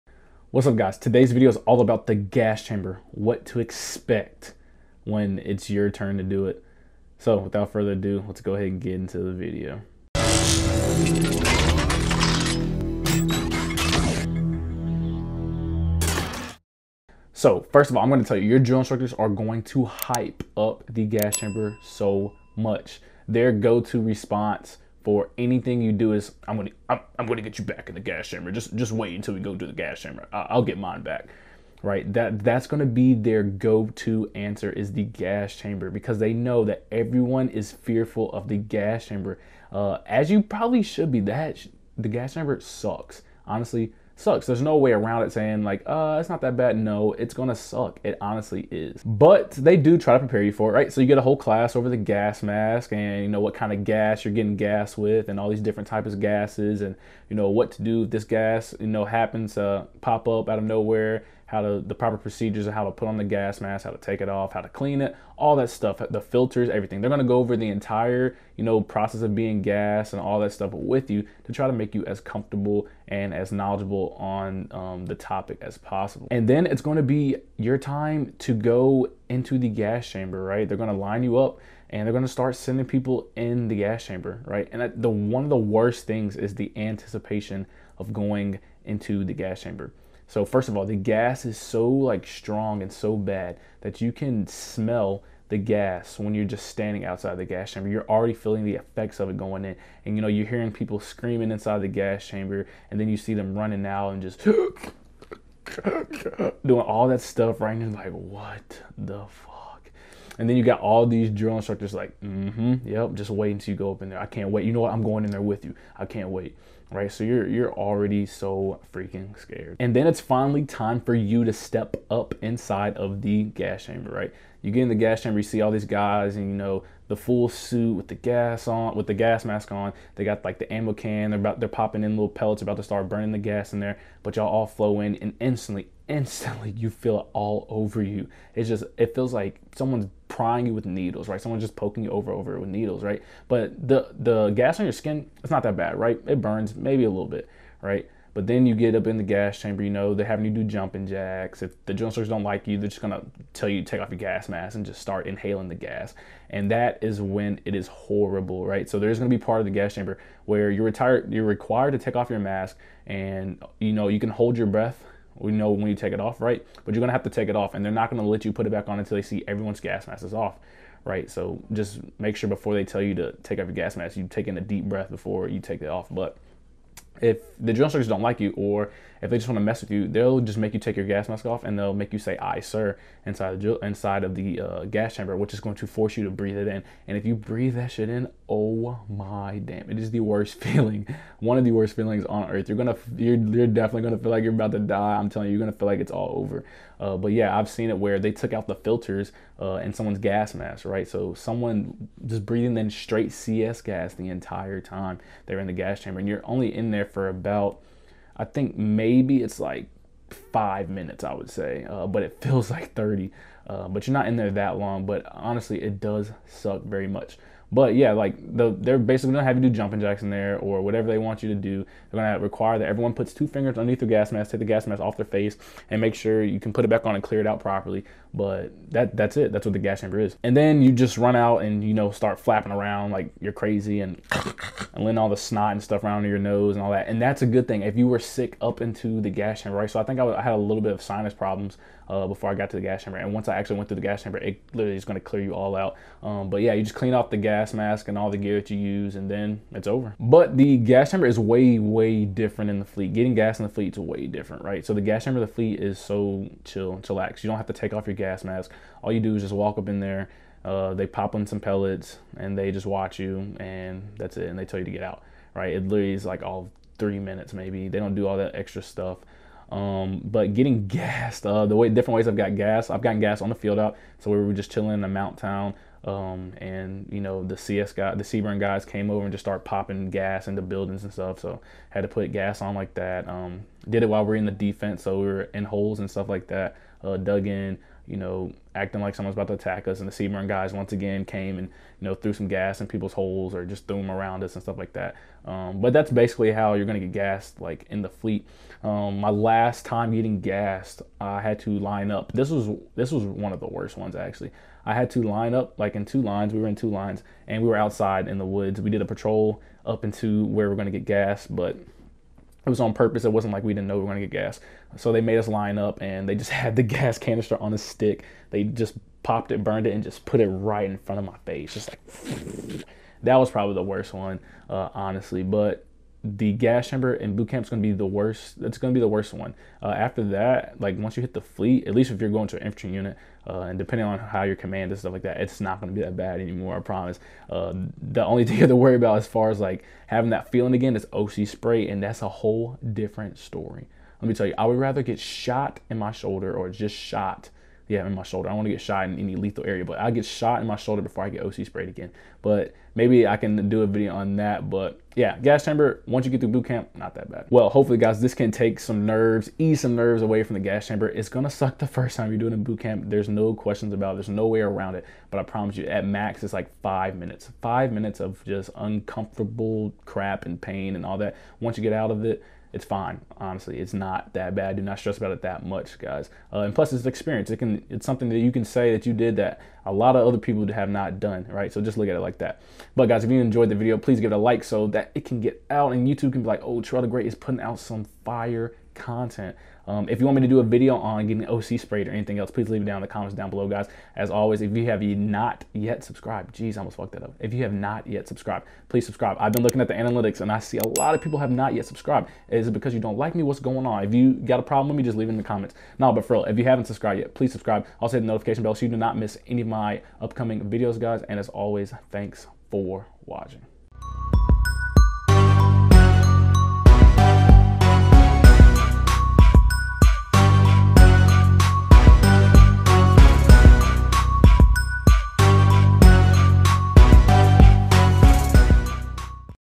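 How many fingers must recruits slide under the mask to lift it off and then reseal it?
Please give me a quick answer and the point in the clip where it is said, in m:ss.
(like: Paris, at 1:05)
2, at 3:43.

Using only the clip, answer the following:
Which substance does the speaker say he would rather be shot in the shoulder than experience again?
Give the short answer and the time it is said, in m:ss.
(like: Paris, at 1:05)
OC spray, at 5:41.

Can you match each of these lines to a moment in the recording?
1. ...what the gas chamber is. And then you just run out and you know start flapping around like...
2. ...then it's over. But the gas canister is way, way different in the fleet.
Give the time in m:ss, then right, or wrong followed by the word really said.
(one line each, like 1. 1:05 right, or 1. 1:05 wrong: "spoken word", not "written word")
1. 3:49 right
2. 4:09 wrong: "chamber", not "canister".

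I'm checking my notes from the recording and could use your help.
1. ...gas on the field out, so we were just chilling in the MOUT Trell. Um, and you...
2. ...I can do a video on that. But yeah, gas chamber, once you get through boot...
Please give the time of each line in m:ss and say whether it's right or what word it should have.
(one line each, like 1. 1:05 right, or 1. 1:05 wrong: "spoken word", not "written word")
1. 4:33 wrong: "Town", not "Trell"
2. 5:53 right.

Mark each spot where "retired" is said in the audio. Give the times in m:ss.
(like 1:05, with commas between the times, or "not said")
2:40.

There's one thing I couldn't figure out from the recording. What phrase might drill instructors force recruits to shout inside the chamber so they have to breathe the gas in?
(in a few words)
Aye sir.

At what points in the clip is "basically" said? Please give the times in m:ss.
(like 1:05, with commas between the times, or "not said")
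3:38, 4:56.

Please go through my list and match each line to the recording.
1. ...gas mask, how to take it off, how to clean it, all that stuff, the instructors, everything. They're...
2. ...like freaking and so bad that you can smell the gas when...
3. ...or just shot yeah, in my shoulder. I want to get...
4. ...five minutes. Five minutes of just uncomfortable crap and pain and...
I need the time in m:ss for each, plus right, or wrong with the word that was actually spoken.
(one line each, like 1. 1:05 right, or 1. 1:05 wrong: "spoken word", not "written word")
1. 1:03 wrong: "filters", not "instructors"
2. 1:31 wrong: "strong", not "freaking"
3. 5:46 right
4. 6:06 right.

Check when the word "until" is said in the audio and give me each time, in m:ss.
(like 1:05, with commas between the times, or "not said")
0:29, 1:53, 2:48.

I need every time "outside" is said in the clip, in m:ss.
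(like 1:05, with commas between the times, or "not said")
1:37, 5:07.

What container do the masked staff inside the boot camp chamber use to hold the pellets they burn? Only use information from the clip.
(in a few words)
Ammo can.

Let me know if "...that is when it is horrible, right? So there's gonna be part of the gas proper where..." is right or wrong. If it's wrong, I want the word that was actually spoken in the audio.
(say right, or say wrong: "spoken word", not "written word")
wrong: "chamber", not "proper".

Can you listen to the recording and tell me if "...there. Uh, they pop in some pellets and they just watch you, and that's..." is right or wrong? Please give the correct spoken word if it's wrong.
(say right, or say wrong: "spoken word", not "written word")
right.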